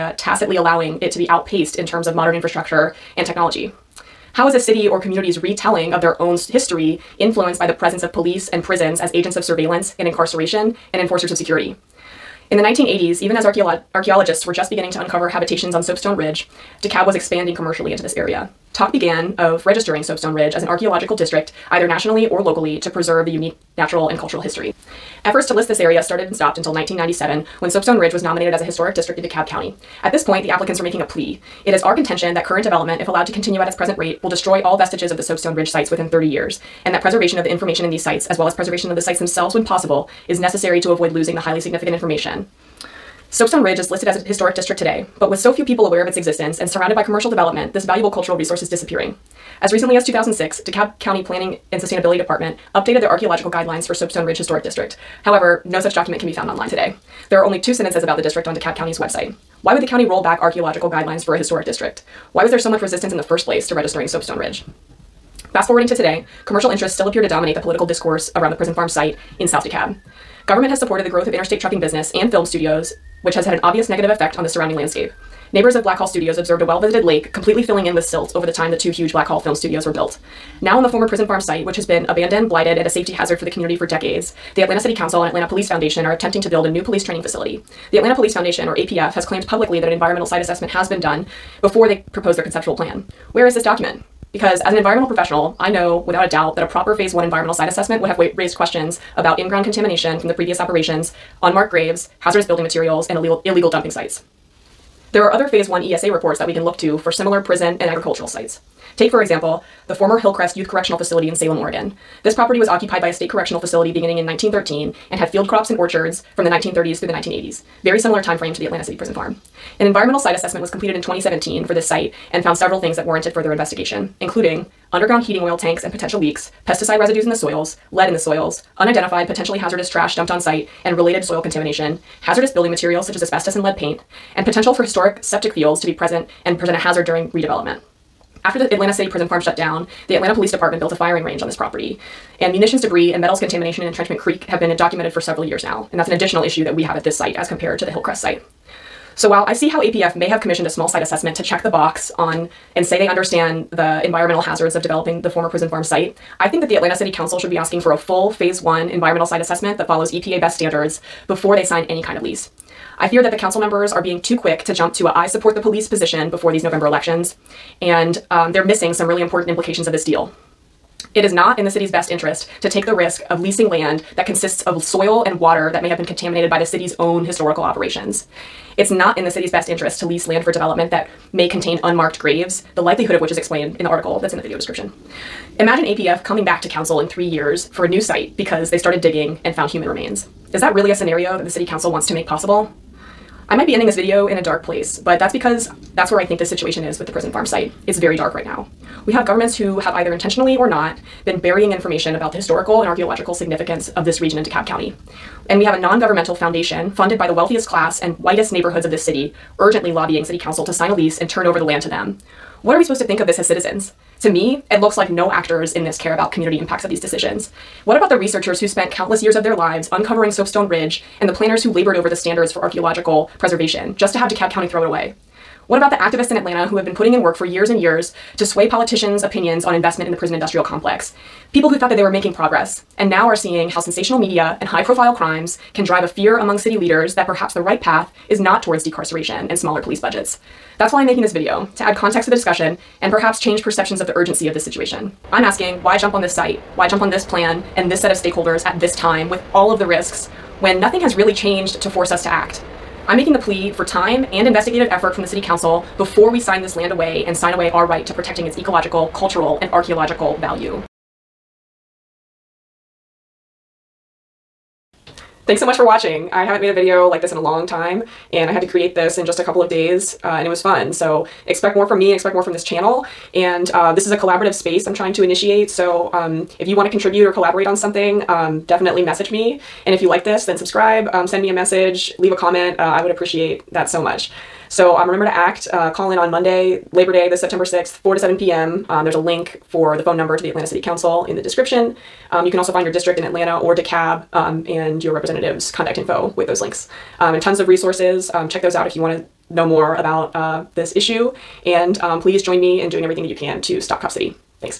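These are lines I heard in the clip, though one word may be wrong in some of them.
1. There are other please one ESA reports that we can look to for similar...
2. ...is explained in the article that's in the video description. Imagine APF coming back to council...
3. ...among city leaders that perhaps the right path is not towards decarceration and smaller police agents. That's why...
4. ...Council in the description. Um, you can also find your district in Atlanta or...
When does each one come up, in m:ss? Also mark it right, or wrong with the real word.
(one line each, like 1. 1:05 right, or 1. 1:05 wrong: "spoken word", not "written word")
1. 1:45 wrong: "phase", not "please"
2. 3:03 right
3. 3:56 wrong: "budgets", not "agents"
4. 4:50 right.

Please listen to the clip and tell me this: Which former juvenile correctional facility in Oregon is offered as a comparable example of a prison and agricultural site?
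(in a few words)
Hillcrest Youth Correctional Facility.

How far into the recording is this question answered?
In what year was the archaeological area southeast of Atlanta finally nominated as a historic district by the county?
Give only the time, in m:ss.
0:26.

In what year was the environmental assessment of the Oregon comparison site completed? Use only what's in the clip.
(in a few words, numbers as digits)
2017.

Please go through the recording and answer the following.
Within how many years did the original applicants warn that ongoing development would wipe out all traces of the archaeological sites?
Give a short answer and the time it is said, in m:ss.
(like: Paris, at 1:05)
30, at 0:36.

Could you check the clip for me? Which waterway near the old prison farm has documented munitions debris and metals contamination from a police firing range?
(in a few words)
Entrenchment Creek.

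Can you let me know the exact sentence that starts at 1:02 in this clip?
Why was there so much resistance in the first place to registering Soapstone Ridge?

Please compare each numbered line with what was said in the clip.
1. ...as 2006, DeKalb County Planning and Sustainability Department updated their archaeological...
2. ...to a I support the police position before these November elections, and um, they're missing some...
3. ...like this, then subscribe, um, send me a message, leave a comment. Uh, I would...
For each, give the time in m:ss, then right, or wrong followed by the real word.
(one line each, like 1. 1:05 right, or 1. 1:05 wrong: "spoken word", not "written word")
1. 0:49 right
2. 2:44 right
3. 4:40 right.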